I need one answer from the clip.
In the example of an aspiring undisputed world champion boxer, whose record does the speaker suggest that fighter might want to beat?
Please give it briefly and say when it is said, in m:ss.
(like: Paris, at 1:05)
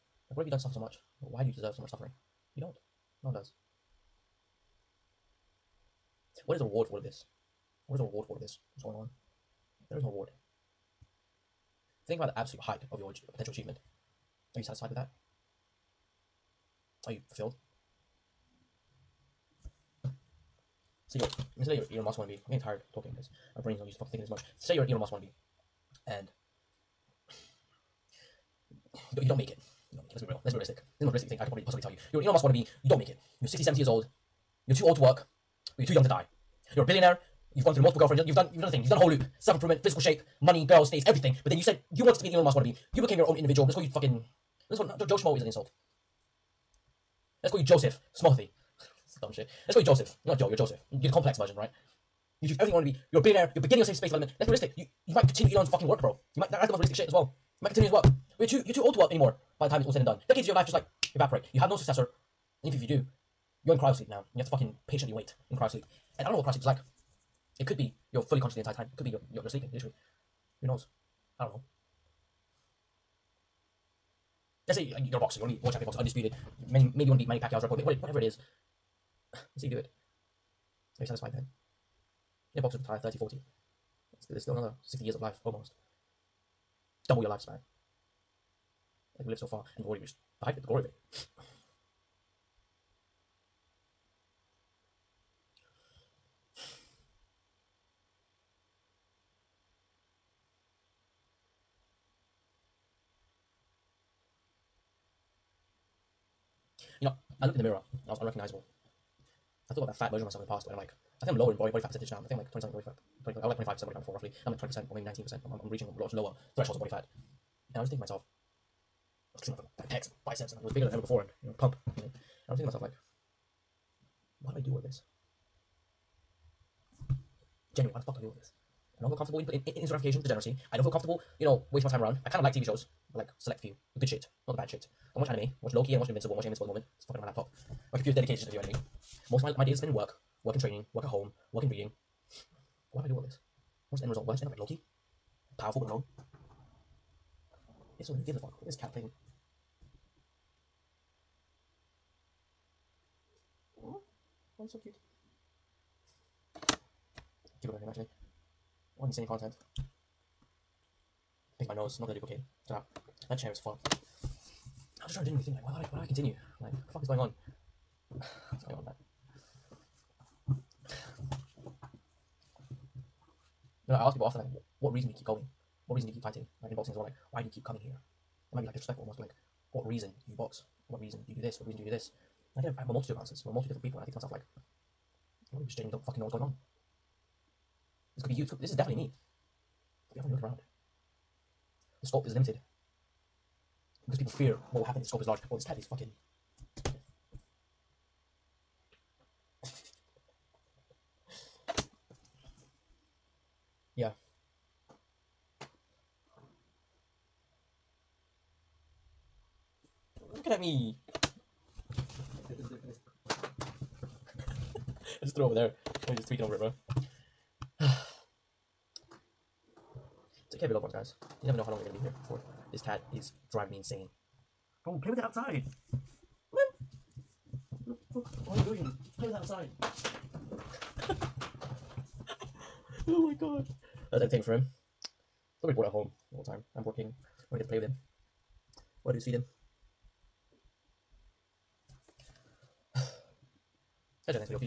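Manny Pacquiao, at 1:17.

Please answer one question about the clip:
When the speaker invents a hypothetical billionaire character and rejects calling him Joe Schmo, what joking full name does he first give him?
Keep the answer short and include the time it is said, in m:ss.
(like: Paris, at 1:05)
Joseph Smothy, at 0:47.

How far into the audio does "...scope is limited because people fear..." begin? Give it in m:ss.
3:12.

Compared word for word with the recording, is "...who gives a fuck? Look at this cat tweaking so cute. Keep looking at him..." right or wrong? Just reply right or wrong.
wrong.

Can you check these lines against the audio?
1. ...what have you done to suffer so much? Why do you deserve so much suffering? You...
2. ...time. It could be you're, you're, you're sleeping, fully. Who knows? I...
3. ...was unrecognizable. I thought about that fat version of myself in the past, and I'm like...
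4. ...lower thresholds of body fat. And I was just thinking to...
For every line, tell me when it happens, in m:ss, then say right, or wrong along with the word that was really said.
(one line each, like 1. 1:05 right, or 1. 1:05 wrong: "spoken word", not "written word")
1. 0:00 right
2. 1:08 wrong: "literally", not "fully"
3. 1:48 right
4. 1:56 right.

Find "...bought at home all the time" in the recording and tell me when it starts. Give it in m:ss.
3:55.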